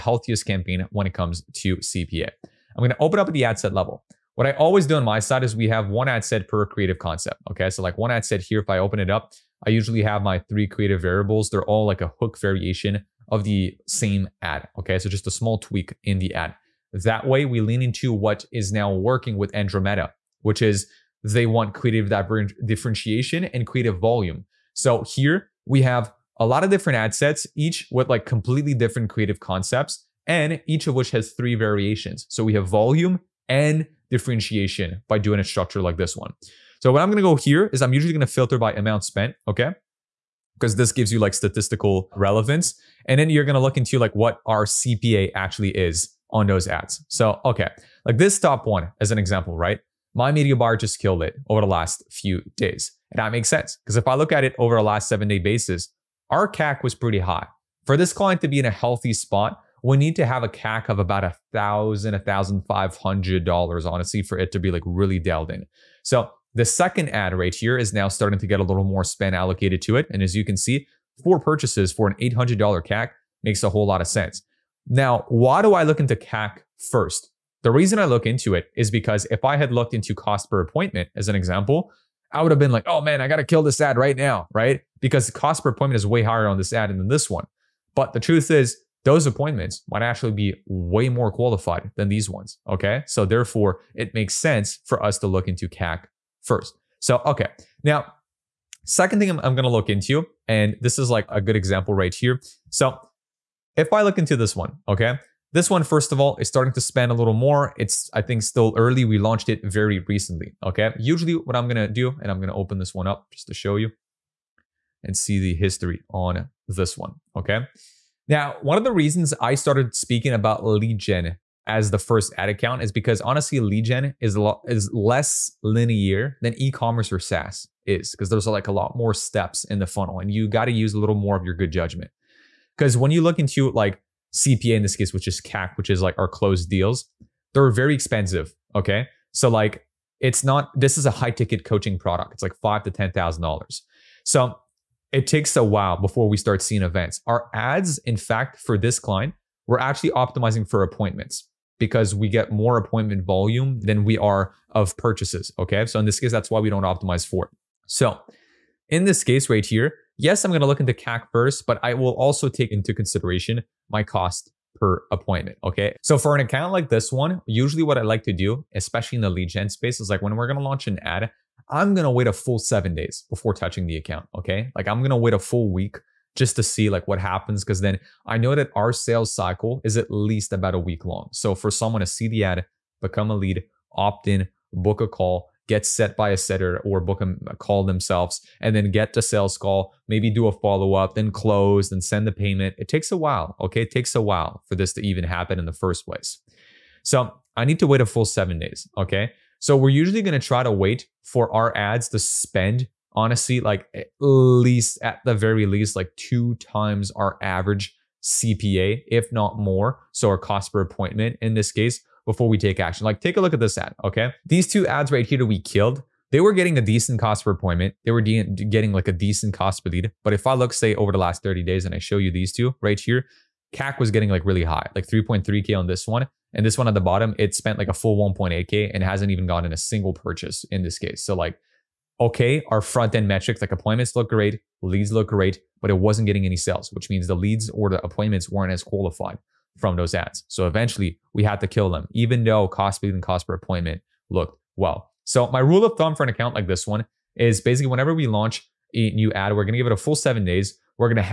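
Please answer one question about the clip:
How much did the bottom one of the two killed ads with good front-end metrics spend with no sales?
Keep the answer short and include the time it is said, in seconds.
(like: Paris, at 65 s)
1.8K, at 228 s.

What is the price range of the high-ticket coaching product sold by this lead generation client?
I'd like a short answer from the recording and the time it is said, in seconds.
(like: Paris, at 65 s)
$5,000 to $10,000, at 142 s.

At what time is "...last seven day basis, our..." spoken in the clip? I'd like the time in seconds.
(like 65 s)
54 s.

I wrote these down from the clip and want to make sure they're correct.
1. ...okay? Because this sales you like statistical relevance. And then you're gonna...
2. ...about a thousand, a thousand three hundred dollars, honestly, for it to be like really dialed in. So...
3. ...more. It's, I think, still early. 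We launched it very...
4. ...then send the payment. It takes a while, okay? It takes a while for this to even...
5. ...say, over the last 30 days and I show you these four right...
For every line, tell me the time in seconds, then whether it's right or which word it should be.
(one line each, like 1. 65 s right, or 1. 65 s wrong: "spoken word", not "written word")
1. 39 s wrong: "gives", not "sales"
2. 60 s wrong: "five", not "three"
3. 107 s right
4. 191 s right
5. 220 s wrong: "two", not "four".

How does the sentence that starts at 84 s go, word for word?
Because the cost per appointment is way higher on this ad than this one.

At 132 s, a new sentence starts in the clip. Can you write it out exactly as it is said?
Because when you look into like CPA in this case, which is CAC, which is like our closed deals, they're very expensive.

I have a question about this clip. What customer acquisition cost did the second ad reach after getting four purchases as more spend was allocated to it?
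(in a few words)
$800.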